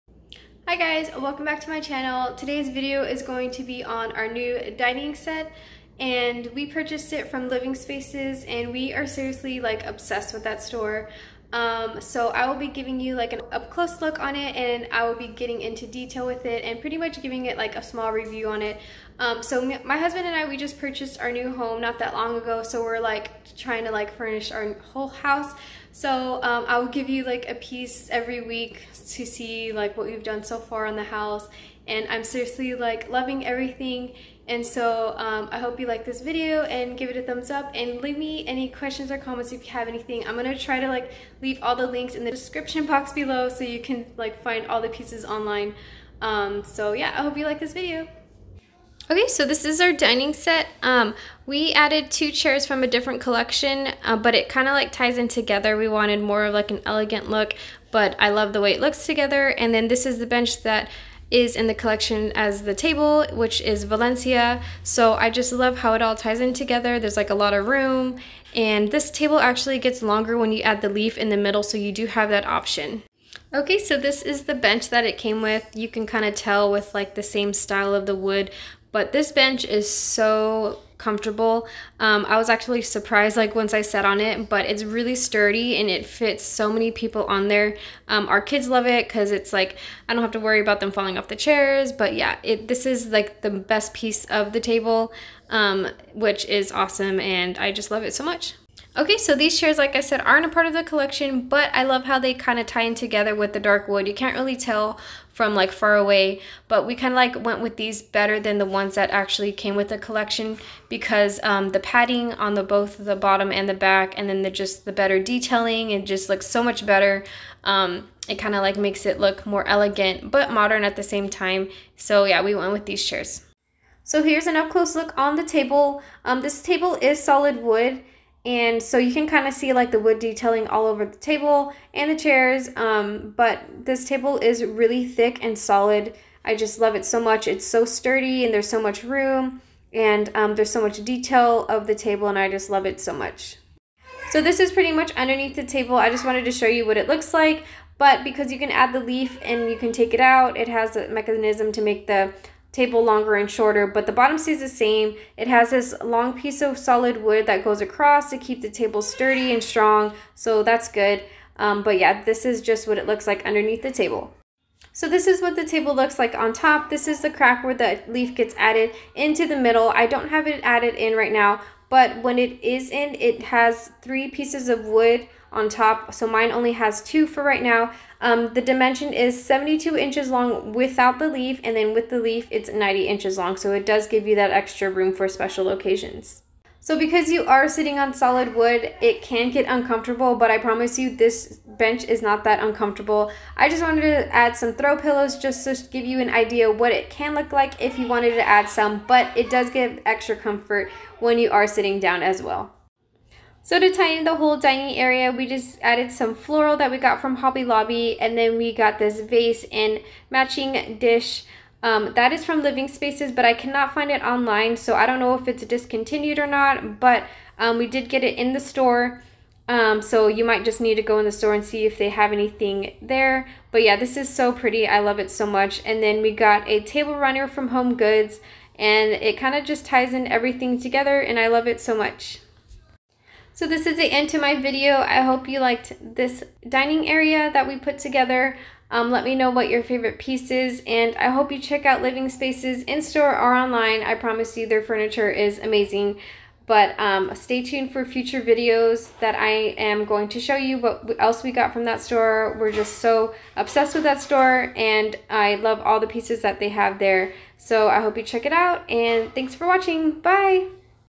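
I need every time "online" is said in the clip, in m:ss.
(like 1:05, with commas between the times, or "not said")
0:45, 3:34, 4:03.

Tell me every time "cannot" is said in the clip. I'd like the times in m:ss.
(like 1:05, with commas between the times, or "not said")
3:33.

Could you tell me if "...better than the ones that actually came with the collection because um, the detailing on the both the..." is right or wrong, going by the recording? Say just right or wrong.
wrong.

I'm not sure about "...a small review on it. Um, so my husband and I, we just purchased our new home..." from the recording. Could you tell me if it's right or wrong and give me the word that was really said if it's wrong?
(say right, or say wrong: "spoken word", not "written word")
right.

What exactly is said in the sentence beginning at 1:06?
There's like a lot of room.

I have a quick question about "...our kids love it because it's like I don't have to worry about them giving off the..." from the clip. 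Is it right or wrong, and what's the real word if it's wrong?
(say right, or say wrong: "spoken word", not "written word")
wrong: "falling", not "giving".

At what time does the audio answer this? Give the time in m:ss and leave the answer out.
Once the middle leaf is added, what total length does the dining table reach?
3:02.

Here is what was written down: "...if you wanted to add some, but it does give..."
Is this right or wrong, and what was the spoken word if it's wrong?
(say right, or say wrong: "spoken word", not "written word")
right.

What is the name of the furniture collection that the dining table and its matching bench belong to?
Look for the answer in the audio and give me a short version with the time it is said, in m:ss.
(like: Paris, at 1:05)
Valencia, at 1:03.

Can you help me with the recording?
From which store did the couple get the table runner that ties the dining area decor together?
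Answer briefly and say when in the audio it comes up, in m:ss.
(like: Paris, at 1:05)
Home Goods, at 3:47.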